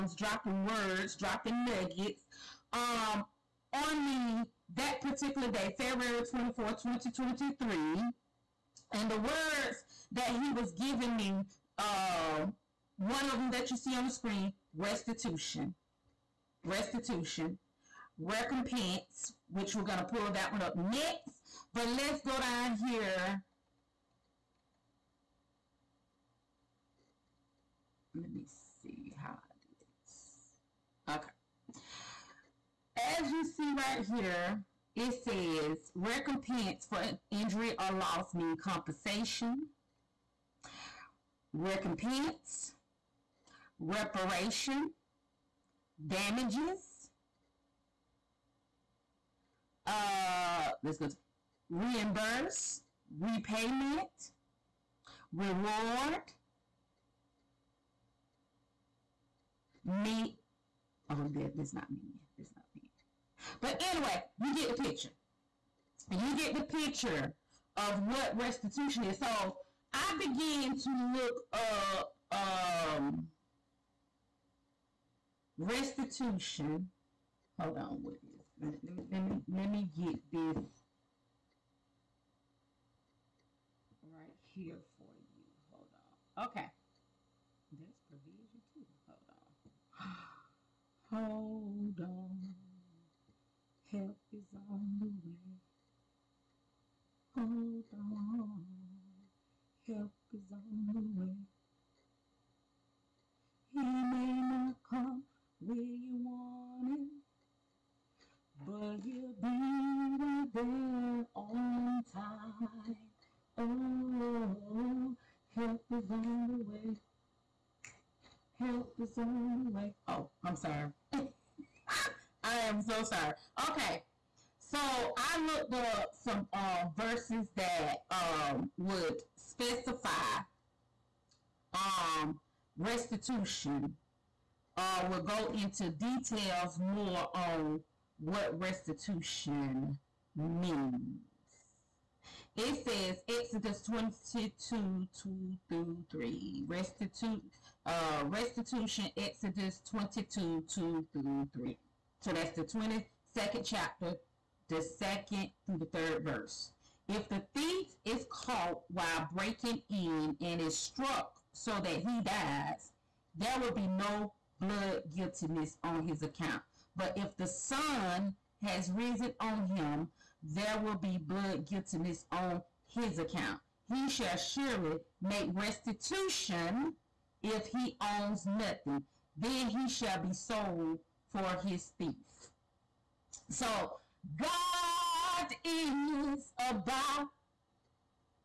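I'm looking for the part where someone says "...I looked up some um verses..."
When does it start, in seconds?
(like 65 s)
125 s.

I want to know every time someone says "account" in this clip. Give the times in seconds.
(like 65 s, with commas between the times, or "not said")
166 s, 173 s.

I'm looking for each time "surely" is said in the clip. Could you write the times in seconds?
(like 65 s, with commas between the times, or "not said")
174 s.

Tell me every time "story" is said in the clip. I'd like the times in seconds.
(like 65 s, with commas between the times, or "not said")
not said.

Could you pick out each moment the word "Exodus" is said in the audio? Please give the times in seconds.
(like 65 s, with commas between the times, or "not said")
143 s, 149 s.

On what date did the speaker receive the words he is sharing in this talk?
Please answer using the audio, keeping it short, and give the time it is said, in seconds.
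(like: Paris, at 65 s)
February 24, 2023, at 5 s.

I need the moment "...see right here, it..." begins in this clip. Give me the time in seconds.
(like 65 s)
33 s.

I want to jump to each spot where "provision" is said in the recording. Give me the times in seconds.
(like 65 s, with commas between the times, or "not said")
88 s.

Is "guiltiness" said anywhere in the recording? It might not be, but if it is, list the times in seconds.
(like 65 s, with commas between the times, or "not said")
165 s, 171 s.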